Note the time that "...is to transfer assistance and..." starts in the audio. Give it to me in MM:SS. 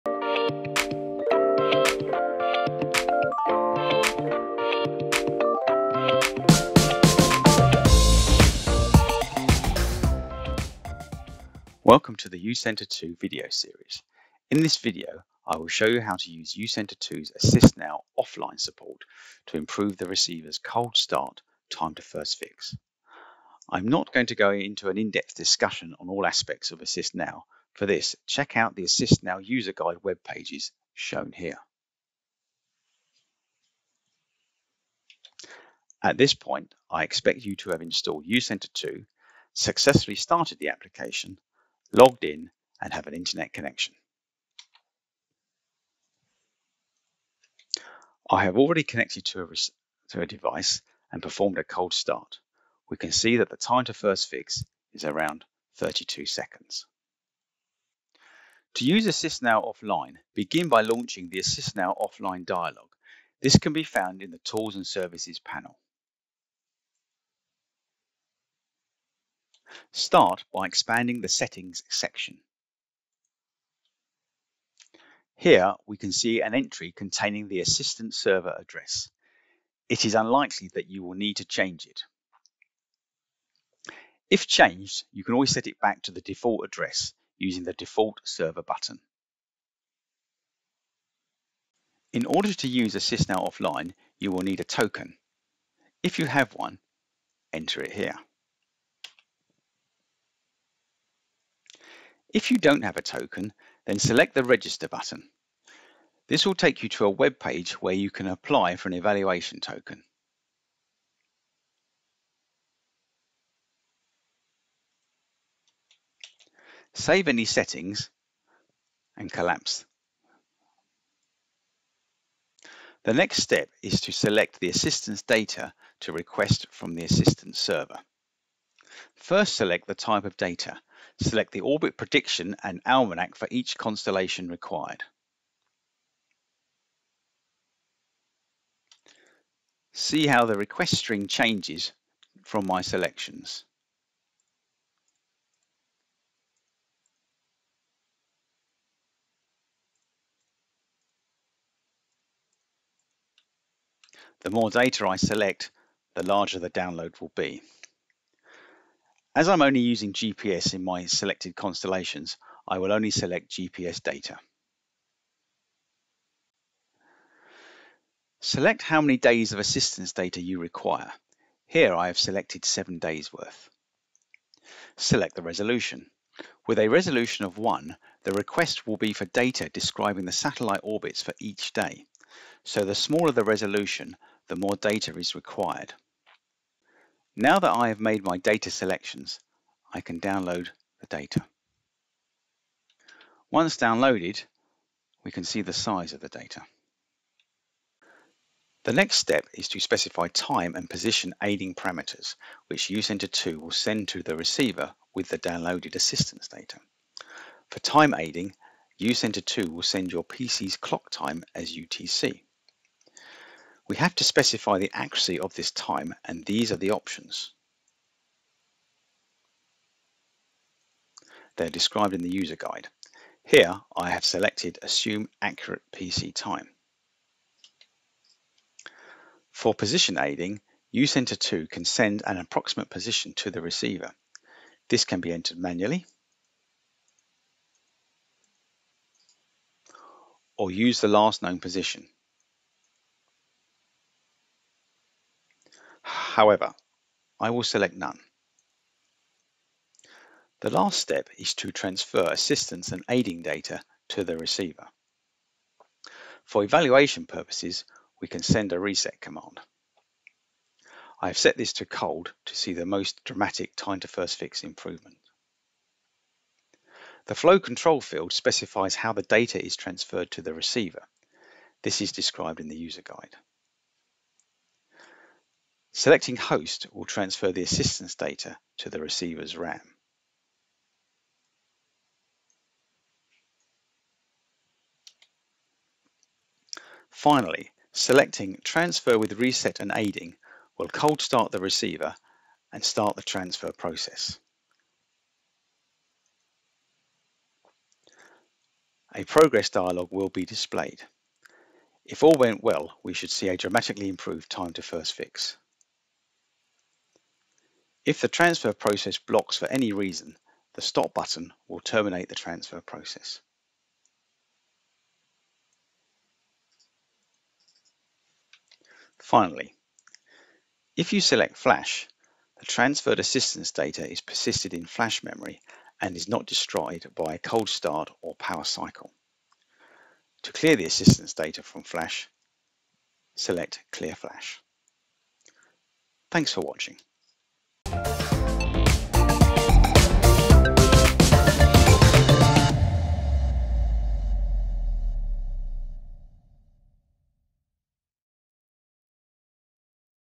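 04:11.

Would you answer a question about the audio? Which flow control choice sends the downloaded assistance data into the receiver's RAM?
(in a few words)
host.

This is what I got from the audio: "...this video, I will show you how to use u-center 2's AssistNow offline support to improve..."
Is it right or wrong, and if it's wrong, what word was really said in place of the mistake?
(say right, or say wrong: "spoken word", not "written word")
right.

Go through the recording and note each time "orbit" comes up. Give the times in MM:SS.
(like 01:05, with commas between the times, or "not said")
02:11, 03:00.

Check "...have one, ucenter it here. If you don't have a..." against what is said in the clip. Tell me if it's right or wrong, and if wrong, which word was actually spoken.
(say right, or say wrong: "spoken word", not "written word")
wrong: "enter", not "ucenter".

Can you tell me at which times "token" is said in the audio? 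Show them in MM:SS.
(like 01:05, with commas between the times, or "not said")
01:34, 01:43, 01:49.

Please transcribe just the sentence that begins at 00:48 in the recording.
I have already connected to a, to a device and performed a cold start.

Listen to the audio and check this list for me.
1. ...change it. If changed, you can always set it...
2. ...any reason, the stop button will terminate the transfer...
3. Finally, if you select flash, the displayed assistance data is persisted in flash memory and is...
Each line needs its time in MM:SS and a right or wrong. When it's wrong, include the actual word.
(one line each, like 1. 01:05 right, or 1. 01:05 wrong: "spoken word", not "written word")
1. 01:21 right
2. 05:09 right
3. 05:19 wrong: "transferred", not "displayed".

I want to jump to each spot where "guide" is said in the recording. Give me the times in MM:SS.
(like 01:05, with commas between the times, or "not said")
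00:29, 03:42, 04:33.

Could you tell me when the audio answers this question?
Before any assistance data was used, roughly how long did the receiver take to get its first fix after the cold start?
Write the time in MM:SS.
00:55.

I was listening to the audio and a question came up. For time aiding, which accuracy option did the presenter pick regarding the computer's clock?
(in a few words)
Assume Accurate PC Time.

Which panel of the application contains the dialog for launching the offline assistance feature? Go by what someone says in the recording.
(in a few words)
Tools and Services.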